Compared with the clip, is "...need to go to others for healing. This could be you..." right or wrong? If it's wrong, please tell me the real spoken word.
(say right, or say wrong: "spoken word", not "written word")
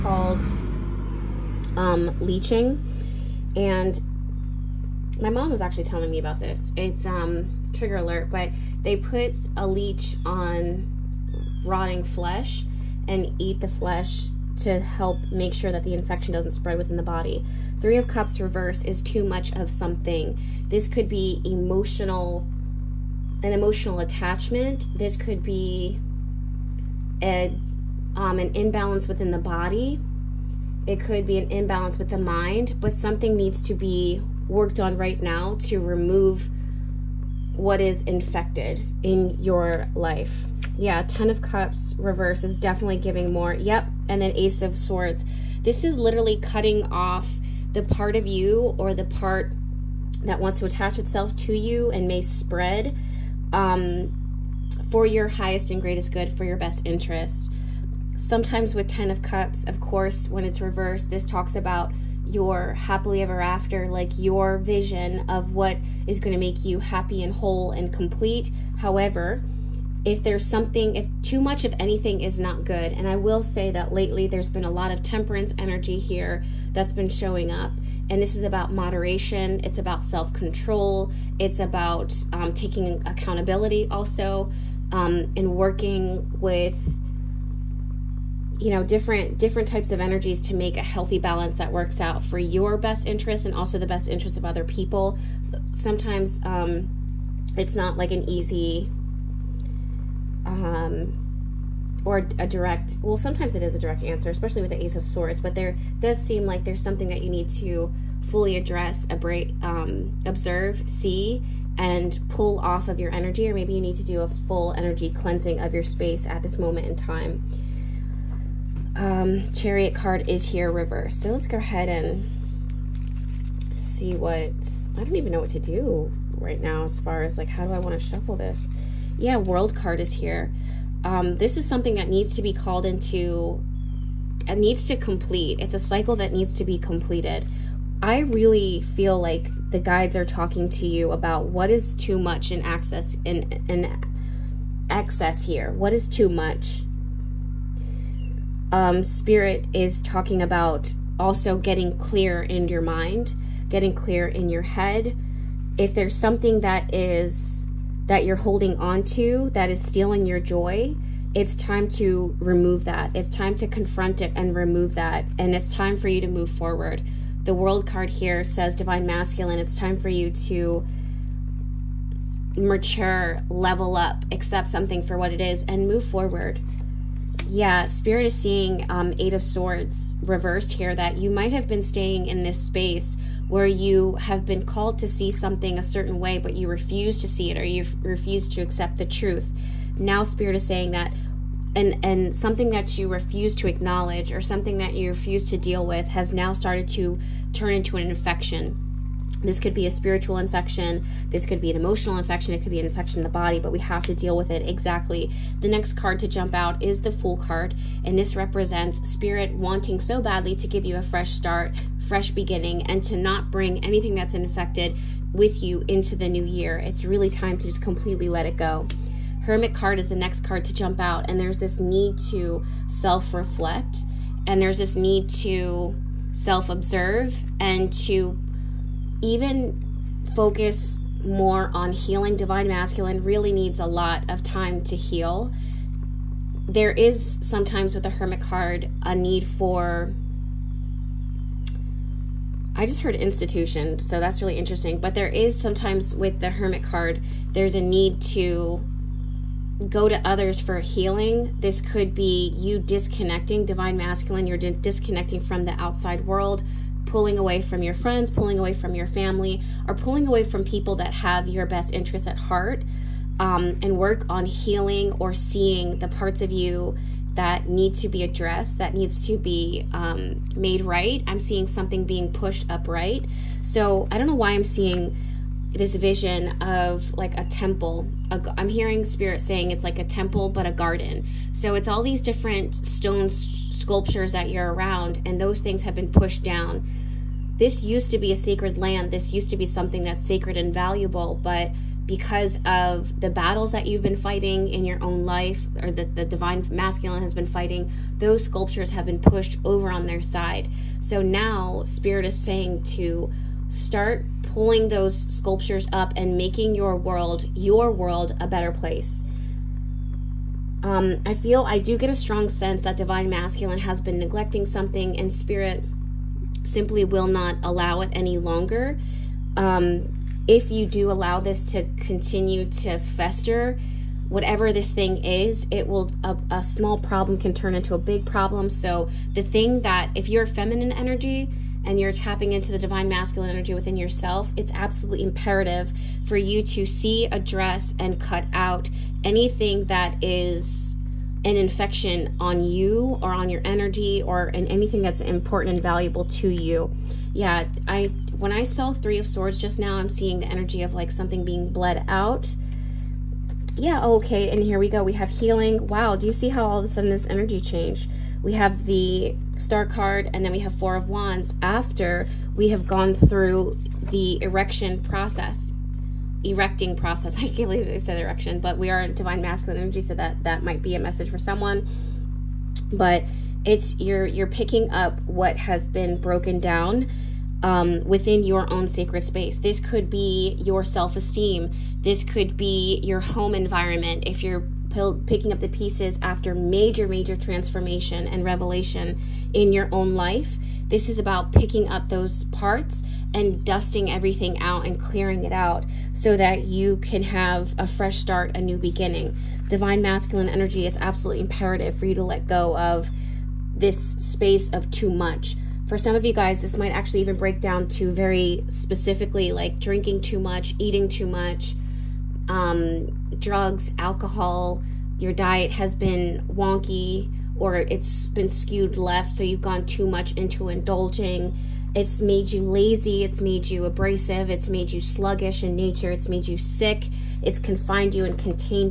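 right.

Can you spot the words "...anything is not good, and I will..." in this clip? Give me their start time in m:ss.
1:11.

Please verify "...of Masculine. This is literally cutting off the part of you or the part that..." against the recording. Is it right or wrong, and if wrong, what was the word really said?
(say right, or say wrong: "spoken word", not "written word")
wrong: "Swords", not "Masculine".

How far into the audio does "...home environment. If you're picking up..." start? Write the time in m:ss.
6:23.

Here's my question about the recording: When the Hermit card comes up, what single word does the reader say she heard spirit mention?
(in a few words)
Institution.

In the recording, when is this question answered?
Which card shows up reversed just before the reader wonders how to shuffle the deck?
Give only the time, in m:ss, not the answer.
1:59.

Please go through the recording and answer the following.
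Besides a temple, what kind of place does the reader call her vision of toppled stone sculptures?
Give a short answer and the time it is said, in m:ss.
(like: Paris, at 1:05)
A garden, at 4:40.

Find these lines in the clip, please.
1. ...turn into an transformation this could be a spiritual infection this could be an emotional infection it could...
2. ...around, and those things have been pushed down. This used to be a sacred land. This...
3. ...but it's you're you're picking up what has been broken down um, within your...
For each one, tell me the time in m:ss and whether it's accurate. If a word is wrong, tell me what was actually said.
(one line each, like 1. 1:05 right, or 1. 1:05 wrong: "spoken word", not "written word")
1. 3:17 wrong: "infection", not "transformation"
2. 4:44 right
3. 6:12 right.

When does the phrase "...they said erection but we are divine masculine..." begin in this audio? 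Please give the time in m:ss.
6:07.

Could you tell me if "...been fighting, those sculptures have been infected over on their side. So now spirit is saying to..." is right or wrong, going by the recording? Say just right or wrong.
wrong.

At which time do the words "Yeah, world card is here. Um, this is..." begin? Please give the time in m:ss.
2:09.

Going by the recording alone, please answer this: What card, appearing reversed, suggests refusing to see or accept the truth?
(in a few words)
Eight of Swords.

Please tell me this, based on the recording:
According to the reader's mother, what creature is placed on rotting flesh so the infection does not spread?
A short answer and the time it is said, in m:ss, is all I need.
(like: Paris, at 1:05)
Leech, at 0:09.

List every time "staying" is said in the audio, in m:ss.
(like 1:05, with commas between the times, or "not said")
3:01.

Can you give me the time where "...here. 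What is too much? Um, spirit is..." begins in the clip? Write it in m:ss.
2:25.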